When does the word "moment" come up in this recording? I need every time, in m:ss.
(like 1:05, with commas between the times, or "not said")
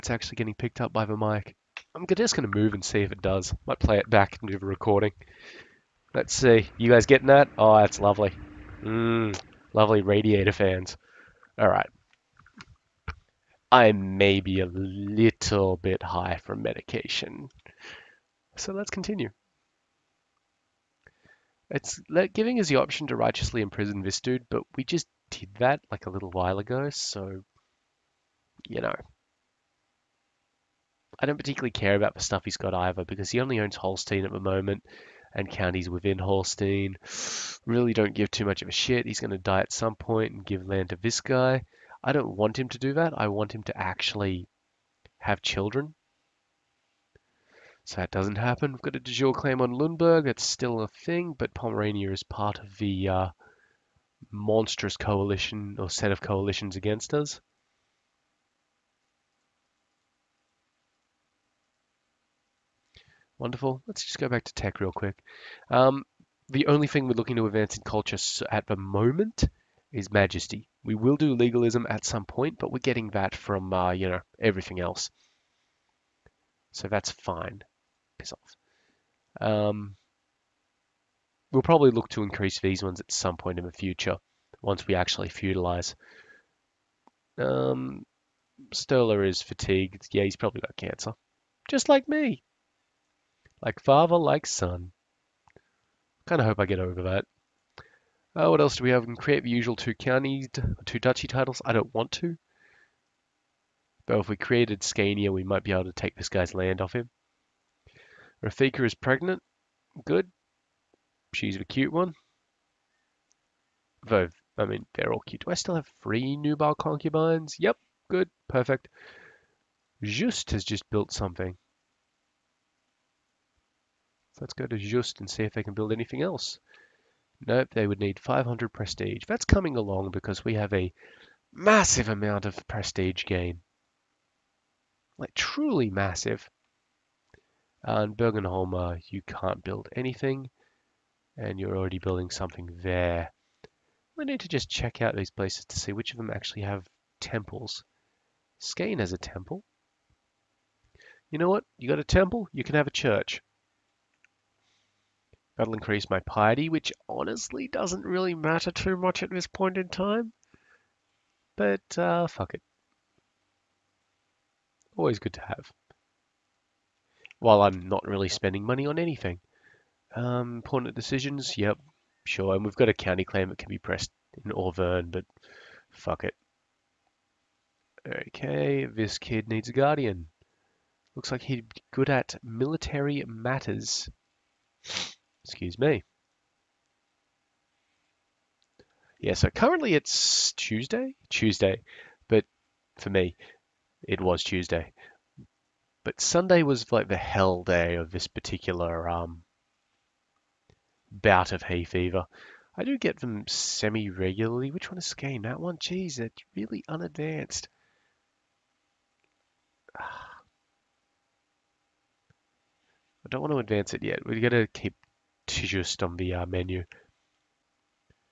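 0:34, 1:08.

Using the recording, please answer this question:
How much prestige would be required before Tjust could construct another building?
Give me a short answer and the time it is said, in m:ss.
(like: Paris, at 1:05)
500, at 2:08.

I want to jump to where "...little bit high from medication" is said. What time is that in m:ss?
0:14.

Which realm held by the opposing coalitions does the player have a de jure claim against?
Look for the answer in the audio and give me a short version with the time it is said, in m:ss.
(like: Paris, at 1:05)
Pomerania, at 0:51.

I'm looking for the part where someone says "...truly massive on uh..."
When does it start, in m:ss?
2:15.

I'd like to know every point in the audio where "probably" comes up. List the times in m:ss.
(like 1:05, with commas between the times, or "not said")
1:21, 1:30.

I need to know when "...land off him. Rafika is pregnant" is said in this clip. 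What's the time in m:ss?
1:46.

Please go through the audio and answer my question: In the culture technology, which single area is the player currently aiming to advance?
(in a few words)
Majesty.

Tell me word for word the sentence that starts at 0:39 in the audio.
He's going to die at some point and give land to this guy.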